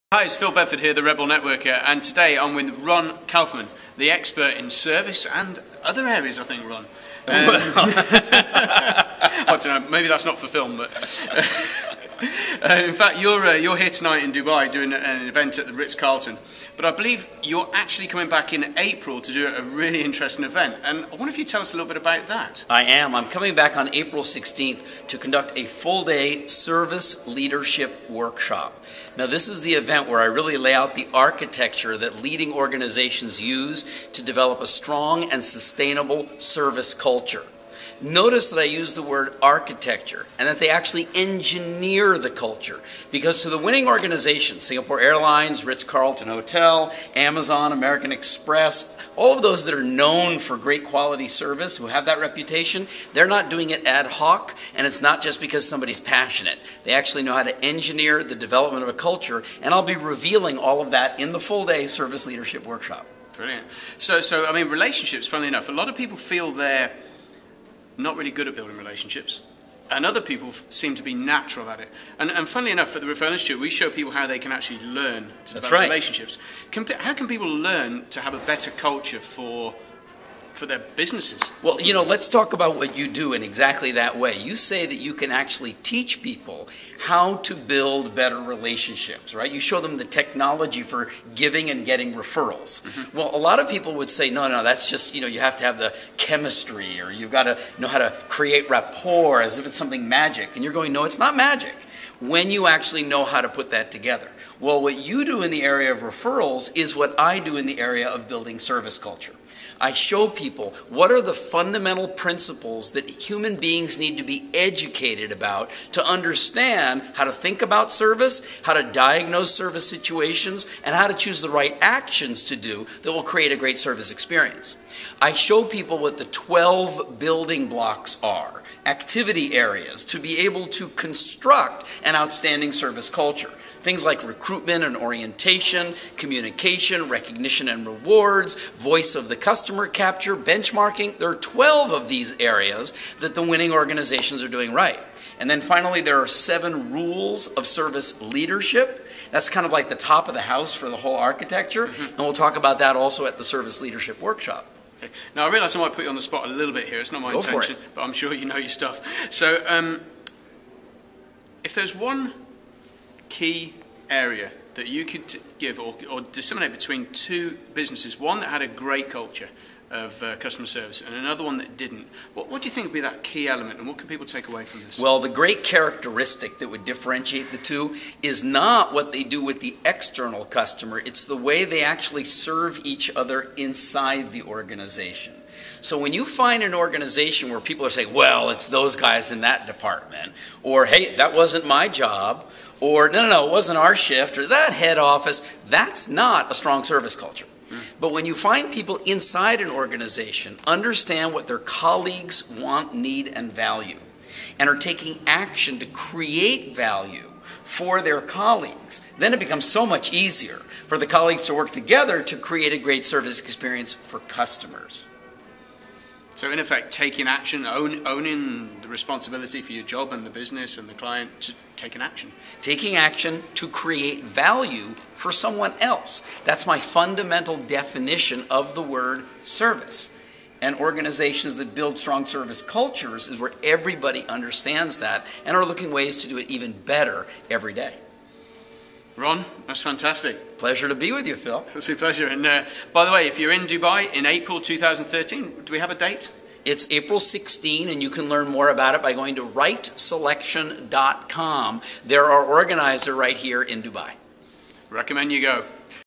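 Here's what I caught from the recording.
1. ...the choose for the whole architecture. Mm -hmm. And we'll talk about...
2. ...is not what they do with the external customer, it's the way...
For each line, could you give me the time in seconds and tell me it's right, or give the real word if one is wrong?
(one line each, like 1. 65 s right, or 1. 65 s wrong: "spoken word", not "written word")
1. 150 s wrong: "house", not "choose"
2. 178 s right.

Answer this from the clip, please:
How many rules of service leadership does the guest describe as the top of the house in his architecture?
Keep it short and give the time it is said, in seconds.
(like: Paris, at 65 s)
7, at 146 s.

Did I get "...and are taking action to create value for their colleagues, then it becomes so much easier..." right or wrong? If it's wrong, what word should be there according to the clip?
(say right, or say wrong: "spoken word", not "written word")
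right.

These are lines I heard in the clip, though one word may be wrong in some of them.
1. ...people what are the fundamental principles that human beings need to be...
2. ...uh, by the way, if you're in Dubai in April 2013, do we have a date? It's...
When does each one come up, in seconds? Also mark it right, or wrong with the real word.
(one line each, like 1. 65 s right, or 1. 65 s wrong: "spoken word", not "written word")
1. 110 s right
2. 242 s right.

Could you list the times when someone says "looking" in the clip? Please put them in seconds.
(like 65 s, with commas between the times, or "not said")
235 s.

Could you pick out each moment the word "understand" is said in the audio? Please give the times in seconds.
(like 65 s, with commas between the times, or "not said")
116 s, 200 s, 234 s.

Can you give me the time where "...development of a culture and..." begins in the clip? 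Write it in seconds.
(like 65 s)
58 s.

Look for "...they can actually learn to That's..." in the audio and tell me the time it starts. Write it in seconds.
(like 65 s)
74 s.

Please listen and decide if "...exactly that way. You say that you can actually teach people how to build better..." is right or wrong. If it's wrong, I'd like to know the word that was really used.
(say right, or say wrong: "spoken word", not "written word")
right.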